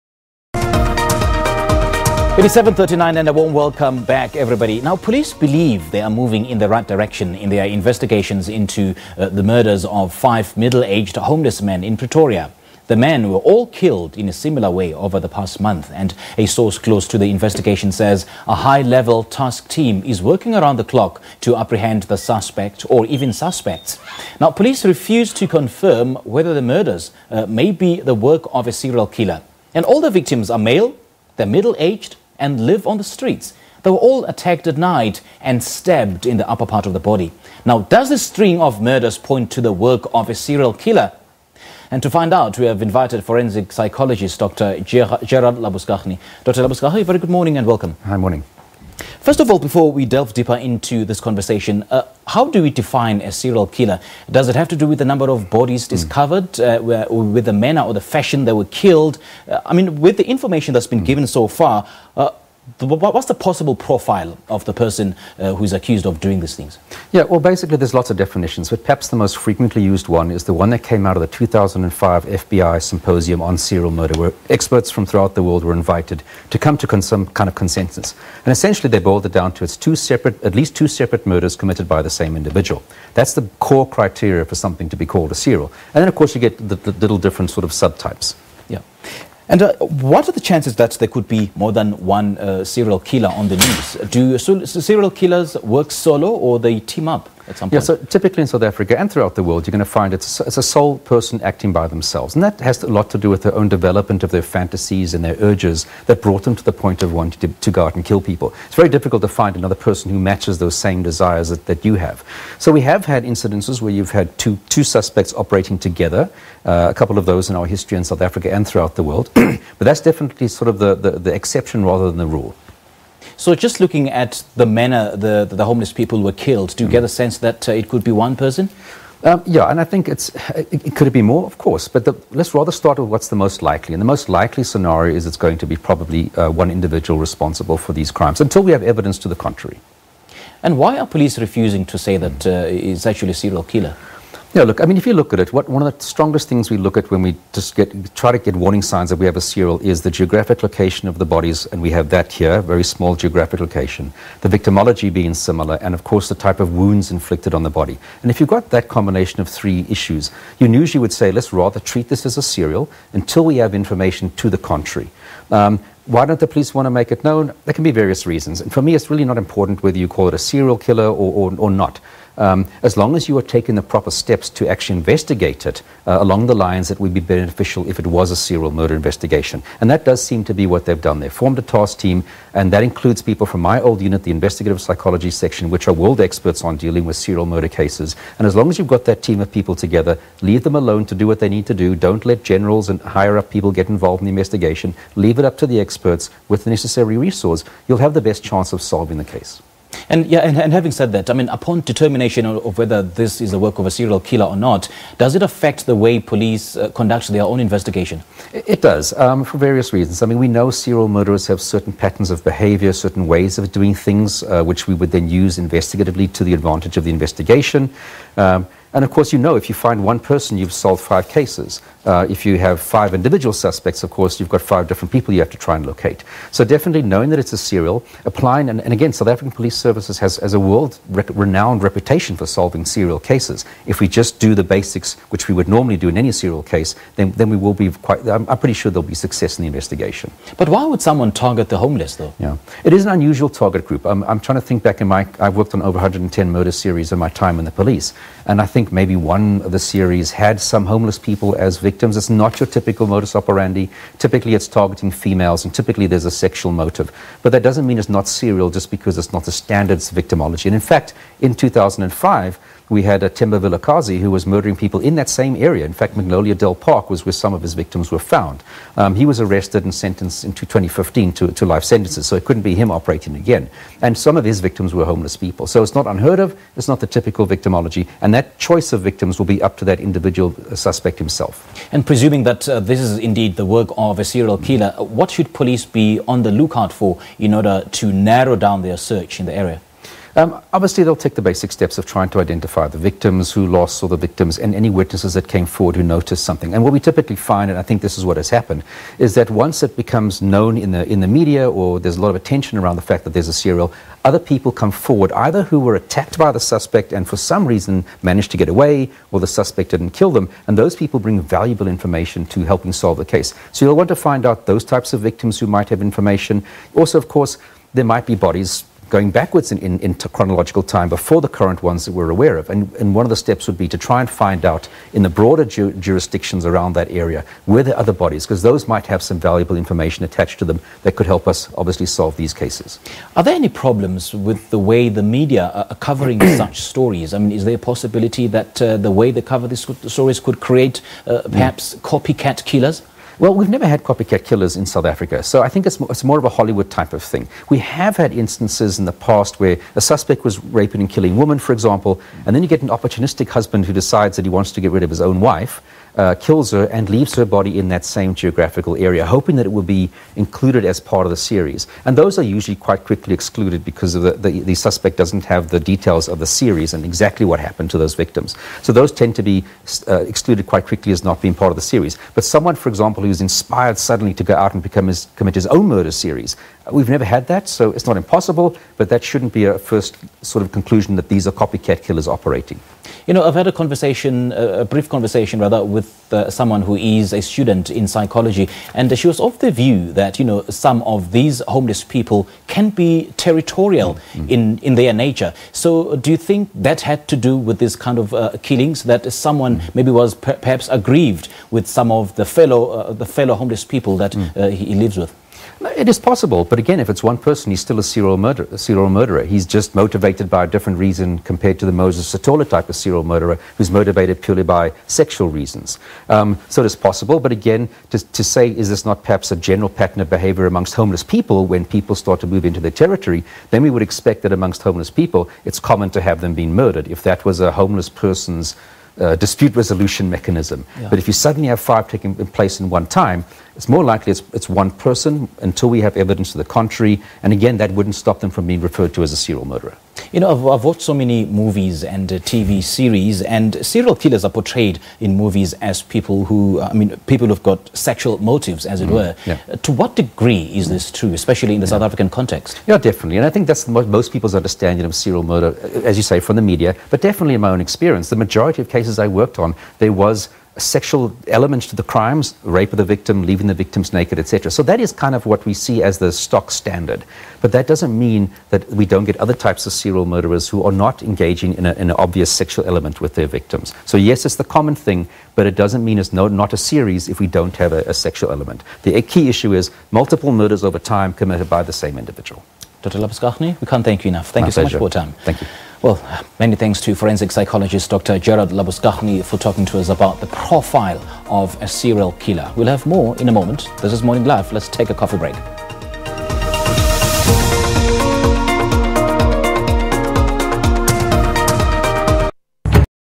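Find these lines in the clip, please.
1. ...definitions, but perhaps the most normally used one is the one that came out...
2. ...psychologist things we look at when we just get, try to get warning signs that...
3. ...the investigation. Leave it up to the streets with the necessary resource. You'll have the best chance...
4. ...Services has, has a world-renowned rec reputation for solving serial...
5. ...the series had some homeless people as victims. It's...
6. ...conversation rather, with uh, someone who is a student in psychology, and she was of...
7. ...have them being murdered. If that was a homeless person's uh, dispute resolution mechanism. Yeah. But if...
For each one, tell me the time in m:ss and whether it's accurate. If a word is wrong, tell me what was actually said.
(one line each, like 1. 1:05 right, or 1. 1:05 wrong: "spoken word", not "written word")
1. 1:08 wrong: "frequently", not "normally"
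2. 2:26 wrong: "strongest", not "psychologist"
3. 3:14 wrong: "experts", not "streets"
4. 3:49 right
5. 4:09 right
6. 6:25 right
7. 7:06 right.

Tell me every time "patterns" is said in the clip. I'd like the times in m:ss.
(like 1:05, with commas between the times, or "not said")
3:31, 6:59.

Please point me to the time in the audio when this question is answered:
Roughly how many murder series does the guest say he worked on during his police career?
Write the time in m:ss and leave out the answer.
4:05.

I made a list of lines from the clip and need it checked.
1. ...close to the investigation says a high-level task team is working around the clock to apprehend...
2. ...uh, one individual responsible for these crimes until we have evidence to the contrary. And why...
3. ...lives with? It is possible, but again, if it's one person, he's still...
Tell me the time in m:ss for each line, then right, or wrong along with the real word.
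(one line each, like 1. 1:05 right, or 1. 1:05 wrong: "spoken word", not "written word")
1. 0:16 right
2. 2:16 right
3. 6:44 right.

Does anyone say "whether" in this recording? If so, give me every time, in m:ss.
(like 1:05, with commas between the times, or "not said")
0:26, 2:49, 3:22.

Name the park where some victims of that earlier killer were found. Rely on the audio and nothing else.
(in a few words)
Magnolia Dell Park.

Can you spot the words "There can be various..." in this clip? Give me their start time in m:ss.
2:47.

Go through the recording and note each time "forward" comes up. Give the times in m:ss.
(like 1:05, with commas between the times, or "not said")
4:55, 5:04.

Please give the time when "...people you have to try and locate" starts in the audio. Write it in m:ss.
3:45.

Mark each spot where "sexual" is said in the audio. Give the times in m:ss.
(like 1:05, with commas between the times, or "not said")
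4:16, 6:55, 7:27, 7:40, 7:52, 7:58.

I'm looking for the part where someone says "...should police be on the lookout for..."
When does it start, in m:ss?
4:45.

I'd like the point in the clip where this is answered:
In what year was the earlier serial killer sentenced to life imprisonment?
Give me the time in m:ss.
4:30.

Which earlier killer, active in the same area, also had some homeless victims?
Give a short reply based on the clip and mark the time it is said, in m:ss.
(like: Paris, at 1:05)
Temba Vilakazi, at 4:23.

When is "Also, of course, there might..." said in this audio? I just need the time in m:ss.
5:16.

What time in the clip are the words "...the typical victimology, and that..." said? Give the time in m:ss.
4:36.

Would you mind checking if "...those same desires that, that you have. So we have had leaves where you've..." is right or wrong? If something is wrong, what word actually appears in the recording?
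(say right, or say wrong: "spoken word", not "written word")
wrong: "incidences", not "leaves".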